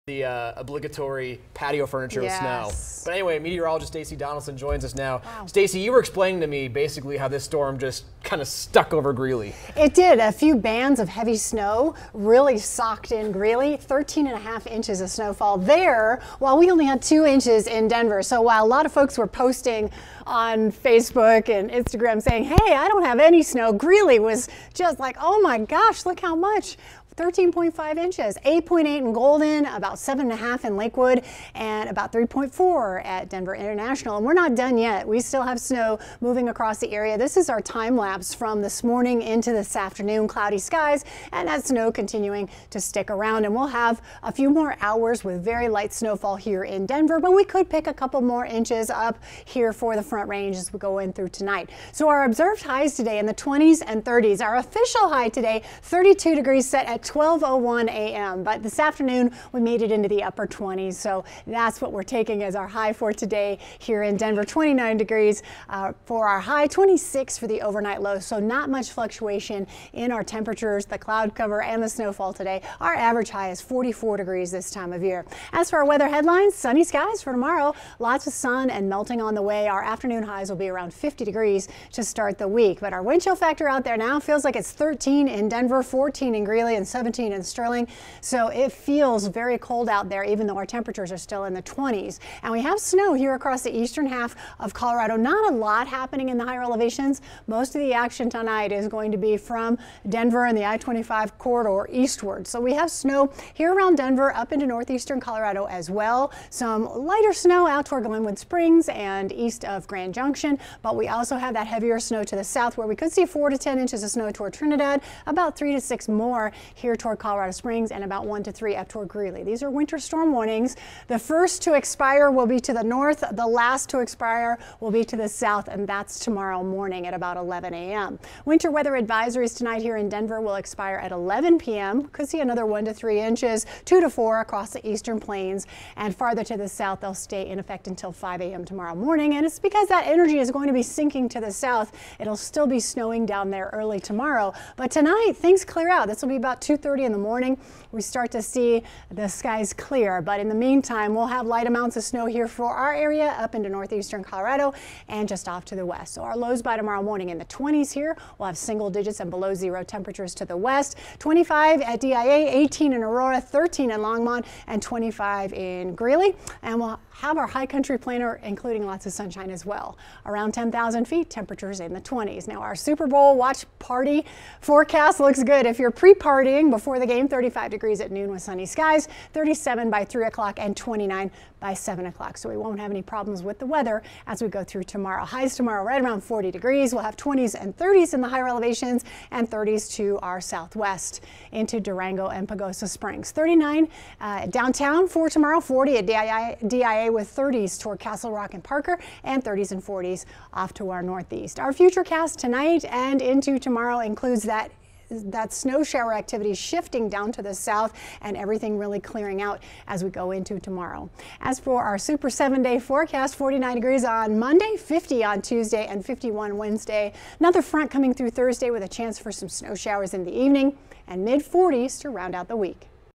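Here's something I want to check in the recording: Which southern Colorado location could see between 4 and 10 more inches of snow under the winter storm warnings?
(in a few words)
Trinidad.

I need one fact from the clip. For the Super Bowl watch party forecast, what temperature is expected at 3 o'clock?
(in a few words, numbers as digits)
37.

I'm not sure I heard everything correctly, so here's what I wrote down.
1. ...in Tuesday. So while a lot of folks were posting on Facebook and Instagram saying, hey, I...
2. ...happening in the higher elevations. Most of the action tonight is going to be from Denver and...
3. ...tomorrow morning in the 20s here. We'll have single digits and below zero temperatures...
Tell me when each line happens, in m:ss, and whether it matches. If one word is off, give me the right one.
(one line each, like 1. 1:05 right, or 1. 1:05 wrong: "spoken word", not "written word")
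1. 0:17 wrong: "Denver", not "Tuesday"
2. 1:35 right
3. 2:36 right.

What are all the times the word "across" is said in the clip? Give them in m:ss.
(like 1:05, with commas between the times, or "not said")
0:36, 1:33, 2:14.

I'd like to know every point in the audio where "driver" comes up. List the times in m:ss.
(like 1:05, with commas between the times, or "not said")
not said.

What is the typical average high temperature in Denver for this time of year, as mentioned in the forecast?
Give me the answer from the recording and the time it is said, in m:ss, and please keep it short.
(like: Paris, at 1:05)
44 degrees, at 1:13.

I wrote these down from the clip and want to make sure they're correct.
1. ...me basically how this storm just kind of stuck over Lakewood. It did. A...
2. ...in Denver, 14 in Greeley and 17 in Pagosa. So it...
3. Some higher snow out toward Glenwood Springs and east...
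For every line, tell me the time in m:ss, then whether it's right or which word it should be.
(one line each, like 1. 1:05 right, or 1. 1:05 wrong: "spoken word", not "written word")
1. 0:06 wrong: "Greeley", not "Lakewood"
2. 1:25 wrong: "Sterling", not "Pagosa"
3. 1:46 wrong: "lighter", not "higher".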